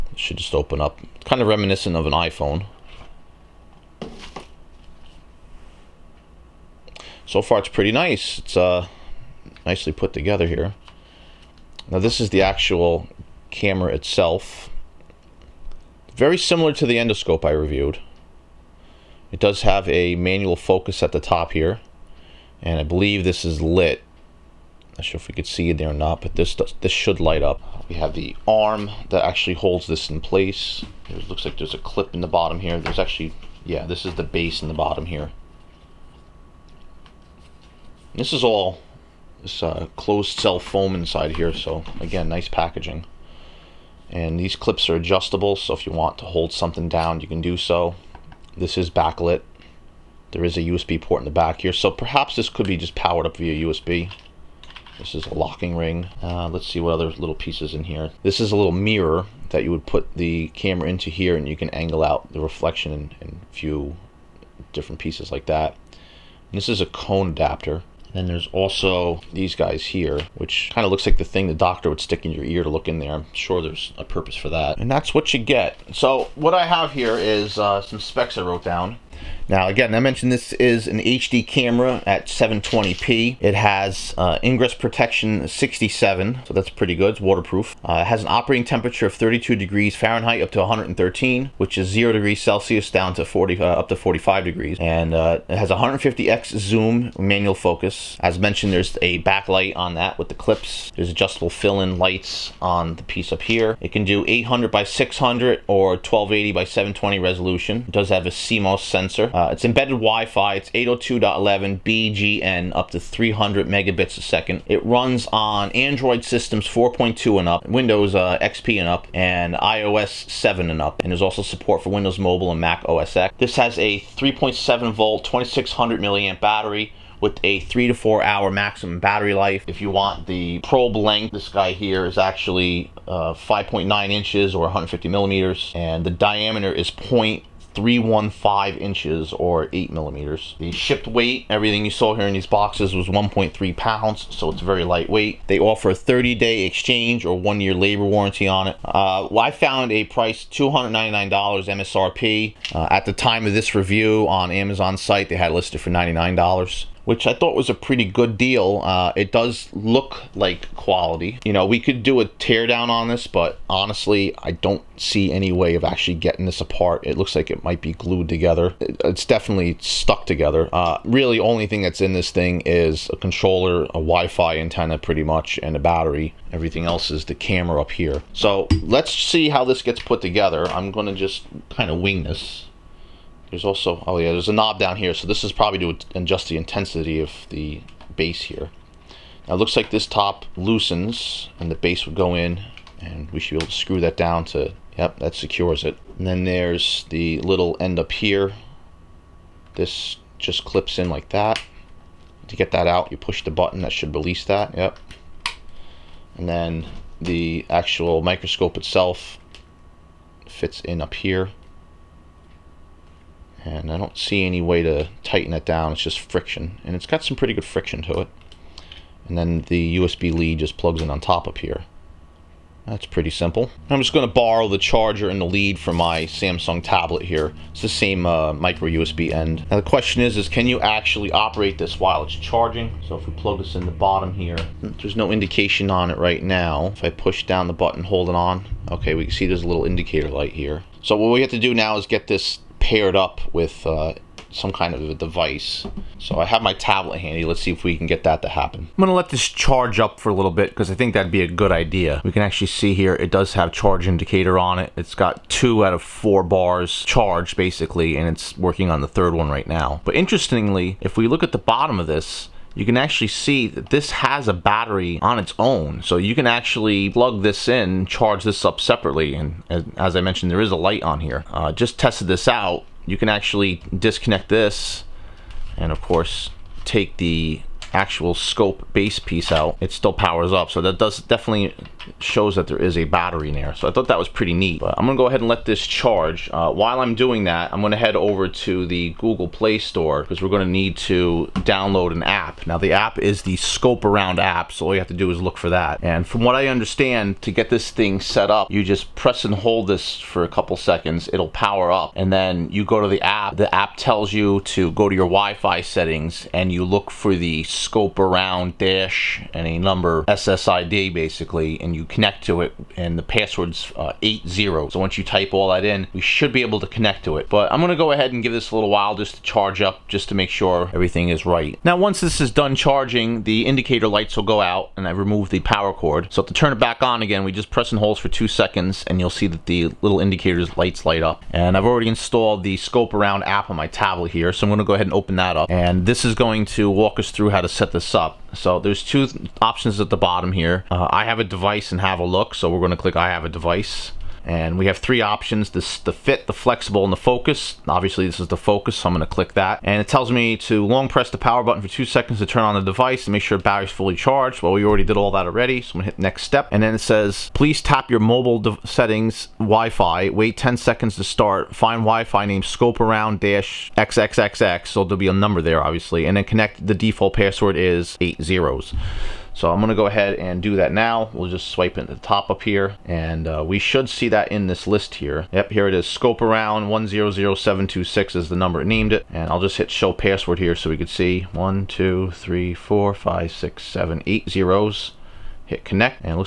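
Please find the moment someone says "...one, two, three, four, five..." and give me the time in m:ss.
6:21.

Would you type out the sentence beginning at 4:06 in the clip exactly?
So I have my tablet handy.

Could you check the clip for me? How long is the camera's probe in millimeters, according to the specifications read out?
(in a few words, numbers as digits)
150 millimeters.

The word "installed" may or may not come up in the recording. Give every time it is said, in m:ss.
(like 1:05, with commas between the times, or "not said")
5:32.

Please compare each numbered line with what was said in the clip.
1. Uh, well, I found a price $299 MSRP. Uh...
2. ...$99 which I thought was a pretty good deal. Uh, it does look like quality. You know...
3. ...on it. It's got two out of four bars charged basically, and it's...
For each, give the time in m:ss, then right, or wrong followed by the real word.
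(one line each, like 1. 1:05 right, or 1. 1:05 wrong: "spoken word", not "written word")
1. 2:28 right
2. 2:35 right
3. 4:14 right.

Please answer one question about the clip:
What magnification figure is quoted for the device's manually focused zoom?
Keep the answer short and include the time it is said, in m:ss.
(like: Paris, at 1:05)
150x, at 1:35.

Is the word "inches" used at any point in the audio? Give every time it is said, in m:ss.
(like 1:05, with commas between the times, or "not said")
2:14, 2:18.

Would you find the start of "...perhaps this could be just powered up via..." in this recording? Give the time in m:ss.
0:51.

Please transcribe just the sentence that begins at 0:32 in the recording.
There's actually, yeah, this is the base in the bottom here.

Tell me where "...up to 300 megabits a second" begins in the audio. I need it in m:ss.
1:52.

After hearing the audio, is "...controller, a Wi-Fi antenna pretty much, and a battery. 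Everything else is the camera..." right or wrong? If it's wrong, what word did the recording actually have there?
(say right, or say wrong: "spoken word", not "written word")
right.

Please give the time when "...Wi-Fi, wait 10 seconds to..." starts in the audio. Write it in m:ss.
5:59.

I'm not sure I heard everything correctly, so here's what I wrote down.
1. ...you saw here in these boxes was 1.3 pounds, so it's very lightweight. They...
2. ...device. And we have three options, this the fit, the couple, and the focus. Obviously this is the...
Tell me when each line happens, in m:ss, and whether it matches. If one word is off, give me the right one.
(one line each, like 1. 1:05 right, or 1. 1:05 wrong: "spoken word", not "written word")
1. 2:21 right
2. 5:43 wrong: "flexible", not "couple".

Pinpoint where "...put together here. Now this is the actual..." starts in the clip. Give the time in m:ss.
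0:09.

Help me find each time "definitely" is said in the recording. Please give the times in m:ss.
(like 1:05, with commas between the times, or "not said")
2:49, 4:41.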